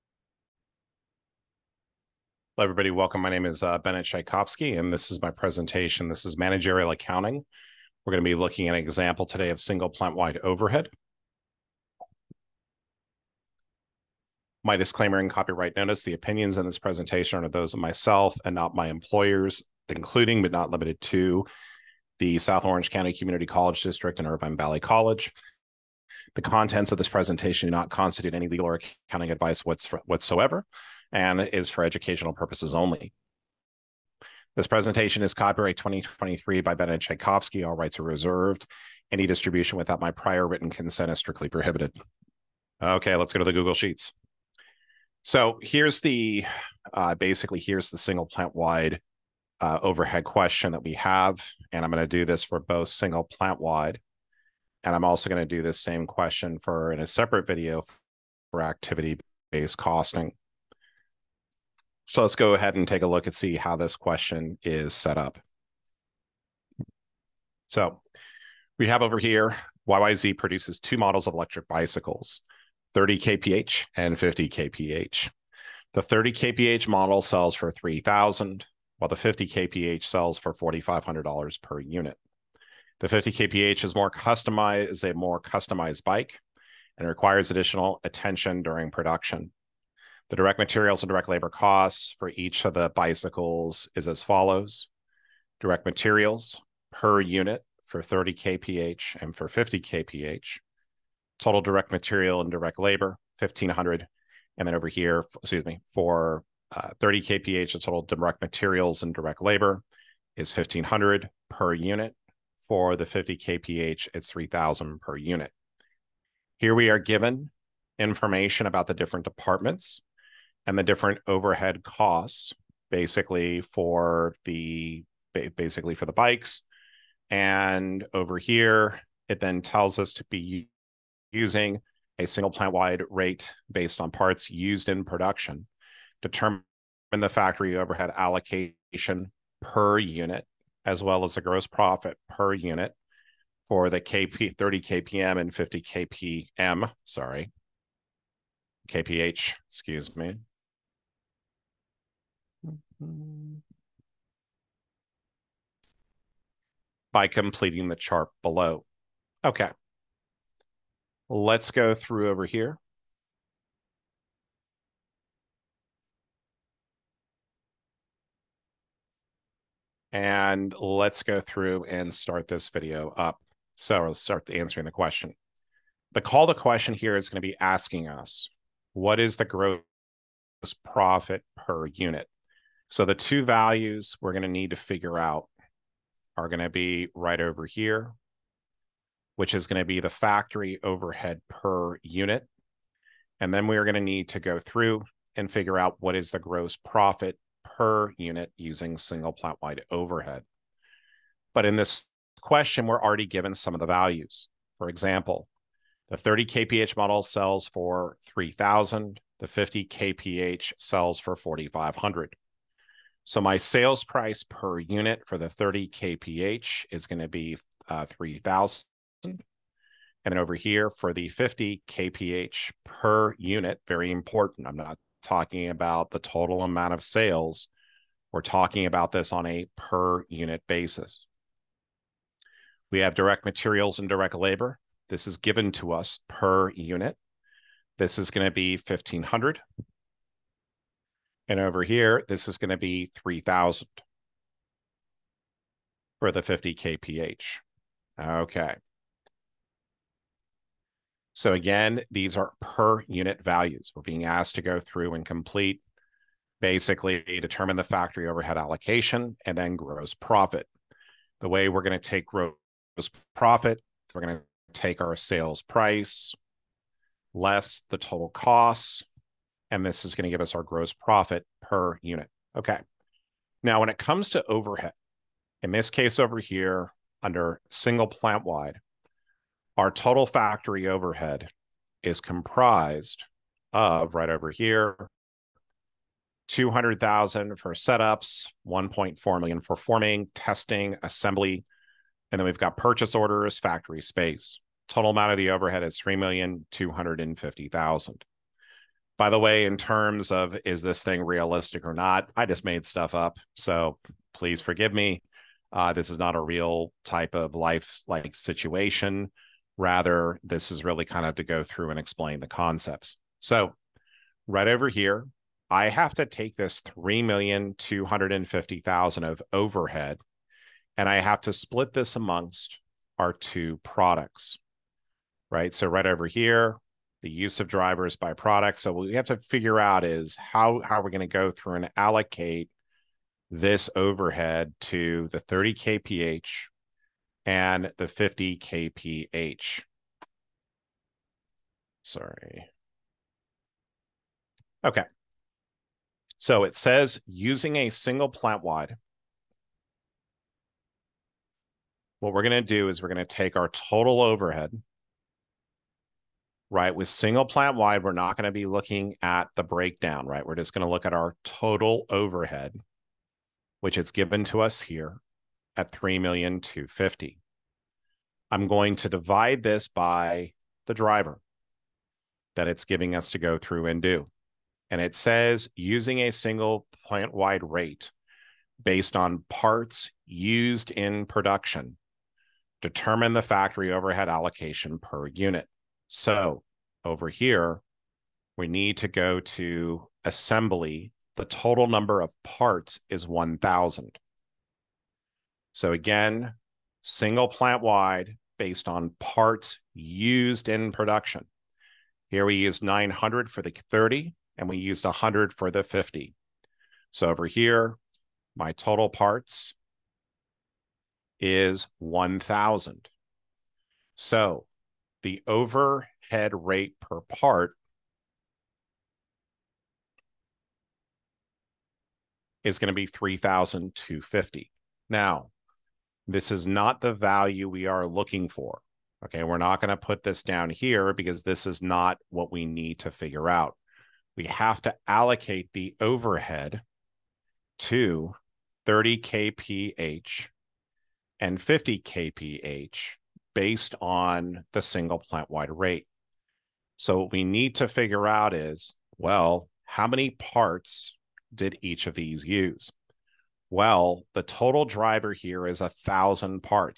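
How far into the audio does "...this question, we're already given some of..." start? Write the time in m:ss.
3:21.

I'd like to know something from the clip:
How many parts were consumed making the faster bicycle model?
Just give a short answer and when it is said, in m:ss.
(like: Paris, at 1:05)
100, at 6:45.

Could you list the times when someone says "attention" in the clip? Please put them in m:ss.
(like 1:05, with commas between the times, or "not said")
1:28.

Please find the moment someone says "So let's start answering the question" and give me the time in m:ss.
2:53.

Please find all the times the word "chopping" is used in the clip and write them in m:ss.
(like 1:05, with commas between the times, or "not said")
not said.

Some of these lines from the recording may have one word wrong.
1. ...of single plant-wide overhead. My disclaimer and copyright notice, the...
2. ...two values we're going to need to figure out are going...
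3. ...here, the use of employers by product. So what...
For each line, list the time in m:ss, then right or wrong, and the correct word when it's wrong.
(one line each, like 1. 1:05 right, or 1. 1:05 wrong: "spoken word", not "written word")
1. 0:09 right
2. 3:03 right
3. 5:26 wrong: "drivers", not "employers".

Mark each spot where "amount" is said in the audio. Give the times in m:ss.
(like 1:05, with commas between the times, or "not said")
3:46, 4:55.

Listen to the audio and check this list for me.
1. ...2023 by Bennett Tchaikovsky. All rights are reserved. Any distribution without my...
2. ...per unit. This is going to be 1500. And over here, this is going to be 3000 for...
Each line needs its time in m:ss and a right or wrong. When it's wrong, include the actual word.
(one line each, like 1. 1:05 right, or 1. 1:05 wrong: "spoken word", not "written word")
1. 0:35 right
2. 3:56 right.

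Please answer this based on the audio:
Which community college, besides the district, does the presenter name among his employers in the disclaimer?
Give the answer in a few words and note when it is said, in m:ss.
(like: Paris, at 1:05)
Irvine Valley College, at 0:24.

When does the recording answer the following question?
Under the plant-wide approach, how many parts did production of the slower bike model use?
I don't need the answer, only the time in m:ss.
6:42.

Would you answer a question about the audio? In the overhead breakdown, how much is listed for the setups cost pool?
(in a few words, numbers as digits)
200,000.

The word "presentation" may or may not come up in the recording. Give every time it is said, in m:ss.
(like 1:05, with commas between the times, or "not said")
0:05, 0:16, 0:27, 0:34.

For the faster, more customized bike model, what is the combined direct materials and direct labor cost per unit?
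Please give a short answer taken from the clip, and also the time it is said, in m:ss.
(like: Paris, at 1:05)
3000 per unit, at 1:54.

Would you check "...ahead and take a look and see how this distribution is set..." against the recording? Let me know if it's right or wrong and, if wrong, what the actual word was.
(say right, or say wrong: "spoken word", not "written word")
wrong: "question", not "distribution".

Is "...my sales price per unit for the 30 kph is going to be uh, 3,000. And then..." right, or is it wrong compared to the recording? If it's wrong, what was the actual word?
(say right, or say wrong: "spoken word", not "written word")
right.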